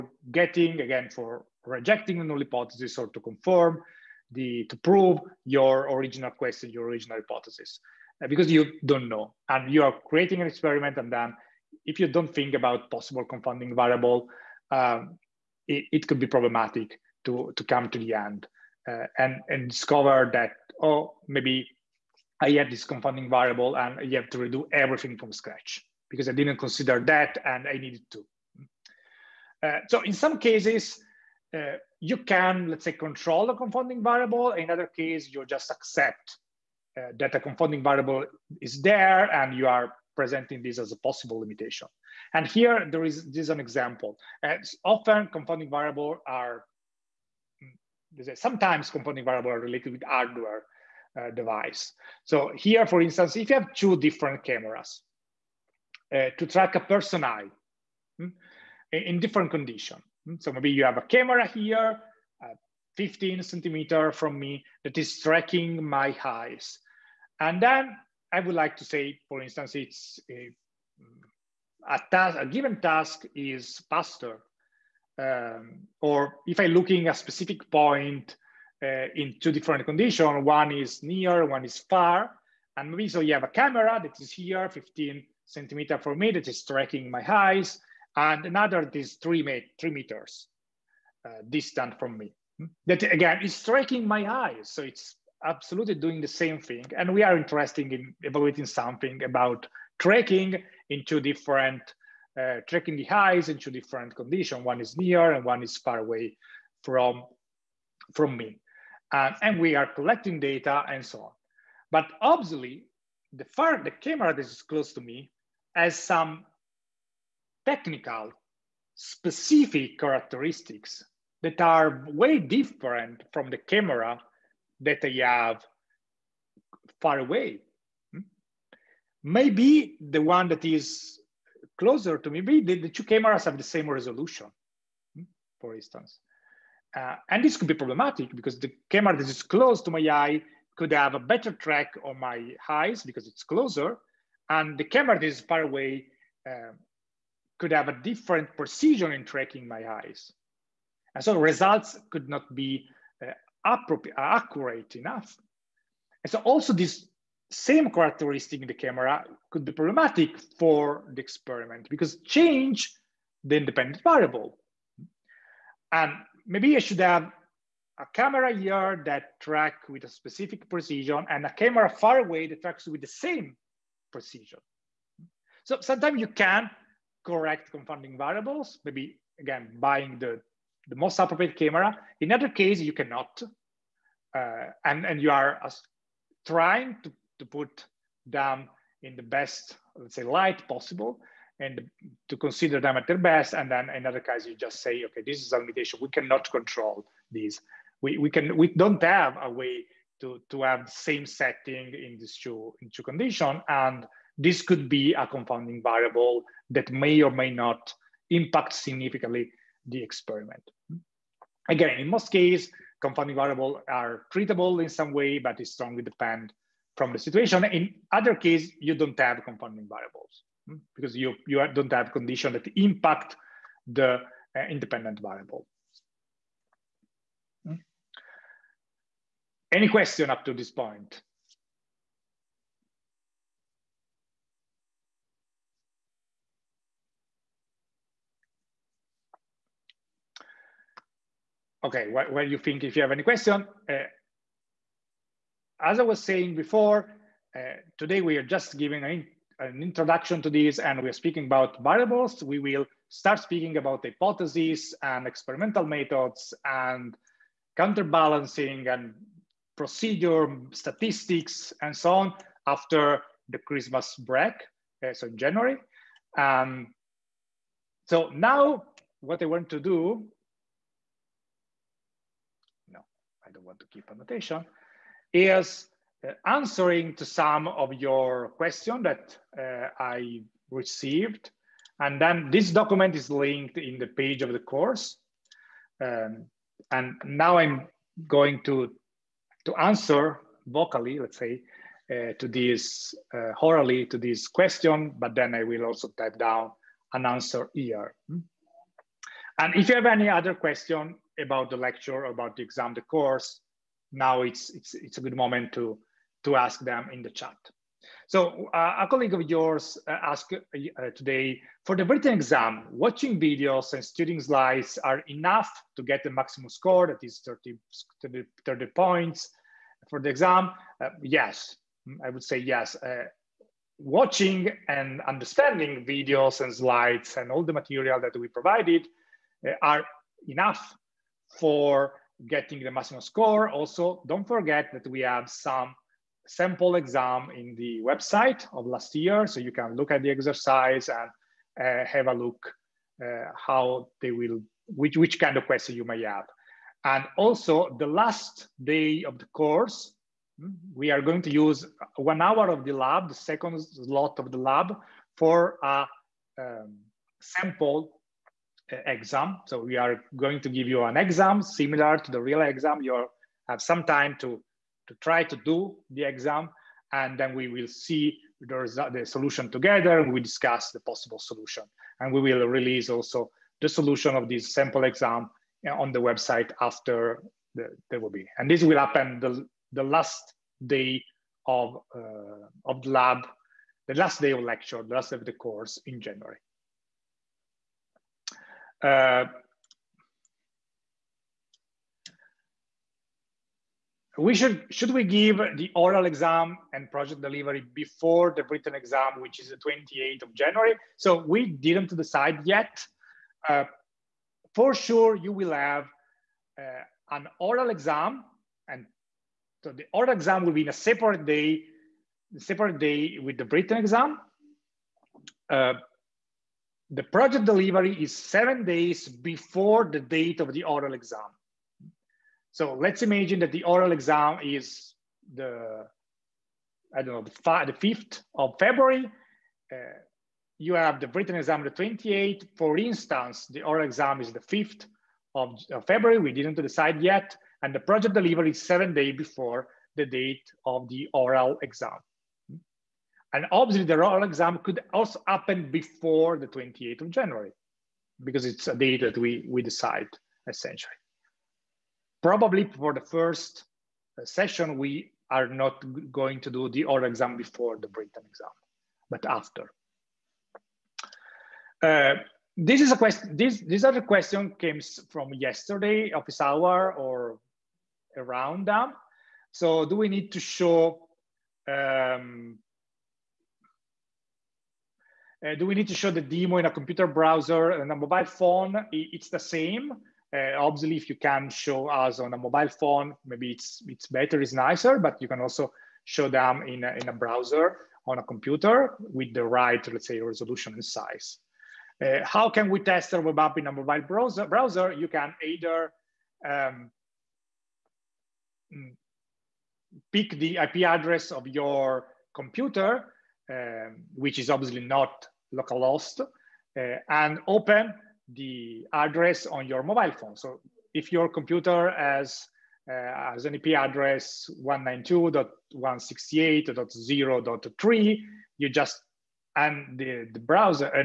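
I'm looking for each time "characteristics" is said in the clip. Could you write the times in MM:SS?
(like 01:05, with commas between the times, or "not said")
01:59, 02:37.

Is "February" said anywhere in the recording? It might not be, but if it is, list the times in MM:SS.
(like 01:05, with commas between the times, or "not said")
07:08, 07:16.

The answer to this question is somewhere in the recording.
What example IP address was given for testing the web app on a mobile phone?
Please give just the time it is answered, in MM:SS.
08:34.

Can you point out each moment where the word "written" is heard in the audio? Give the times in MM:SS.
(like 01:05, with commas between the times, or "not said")
05:12, 06:38, 06:53, 07:11, 07:38.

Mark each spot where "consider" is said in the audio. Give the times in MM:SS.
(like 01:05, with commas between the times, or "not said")
00:26, 03:12.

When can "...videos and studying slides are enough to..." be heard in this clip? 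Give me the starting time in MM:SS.
05:13.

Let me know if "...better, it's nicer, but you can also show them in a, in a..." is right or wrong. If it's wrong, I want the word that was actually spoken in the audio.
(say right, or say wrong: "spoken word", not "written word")
right.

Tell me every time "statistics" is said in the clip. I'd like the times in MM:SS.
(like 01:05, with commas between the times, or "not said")
04:20.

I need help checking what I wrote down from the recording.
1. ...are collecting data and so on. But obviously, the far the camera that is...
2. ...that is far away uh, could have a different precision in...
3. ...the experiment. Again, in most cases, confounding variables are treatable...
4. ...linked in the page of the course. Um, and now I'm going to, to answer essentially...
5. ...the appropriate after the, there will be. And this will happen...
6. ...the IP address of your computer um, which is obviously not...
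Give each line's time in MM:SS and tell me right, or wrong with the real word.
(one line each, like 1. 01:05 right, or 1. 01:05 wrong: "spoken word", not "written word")
1. 01:49 right
2. 02:25 right
3. 03:29 right
4. 04:43 wrong: "vocally", not "essentially"
5. 06:16 wrong: "website", not "appropriate"
6. 08:20 right.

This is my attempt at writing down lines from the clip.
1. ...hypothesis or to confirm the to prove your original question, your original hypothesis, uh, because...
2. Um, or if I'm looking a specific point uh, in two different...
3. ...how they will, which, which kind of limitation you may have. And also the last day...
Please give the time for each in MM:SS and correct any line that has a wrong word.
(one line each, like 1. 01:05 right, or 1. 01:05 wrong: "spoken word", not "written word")
1. 00:02 right
2. 01:15 right
3. 05:43 wrong: "question", not "limitation".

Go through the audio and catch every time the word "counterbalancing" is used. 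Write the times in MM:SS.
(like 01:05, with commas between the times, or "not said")
04:17.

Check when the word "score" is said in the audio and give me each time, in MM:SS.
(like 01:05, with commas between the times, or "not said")
05:16, 05:33.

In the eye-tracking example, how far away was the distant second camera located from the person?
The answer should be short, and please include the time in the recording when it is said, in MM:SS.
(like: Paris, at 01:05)
3 meters, at 01:29.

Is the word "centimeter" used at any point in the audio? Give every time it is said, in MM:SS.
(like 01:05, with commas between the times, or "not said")
01:03, 01:25.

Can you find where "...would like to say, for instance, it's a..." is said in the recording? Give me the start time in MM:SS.
01:08.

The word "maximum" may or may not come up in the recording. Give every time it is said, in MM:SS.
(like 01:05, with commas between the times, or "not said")
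05:16, 05:32.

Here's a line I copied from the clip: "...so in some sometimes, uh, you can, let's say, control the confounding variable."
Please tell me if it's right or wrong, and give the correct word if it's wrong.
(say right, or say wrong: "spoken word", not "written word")
wrong: "cases", not "sometimes".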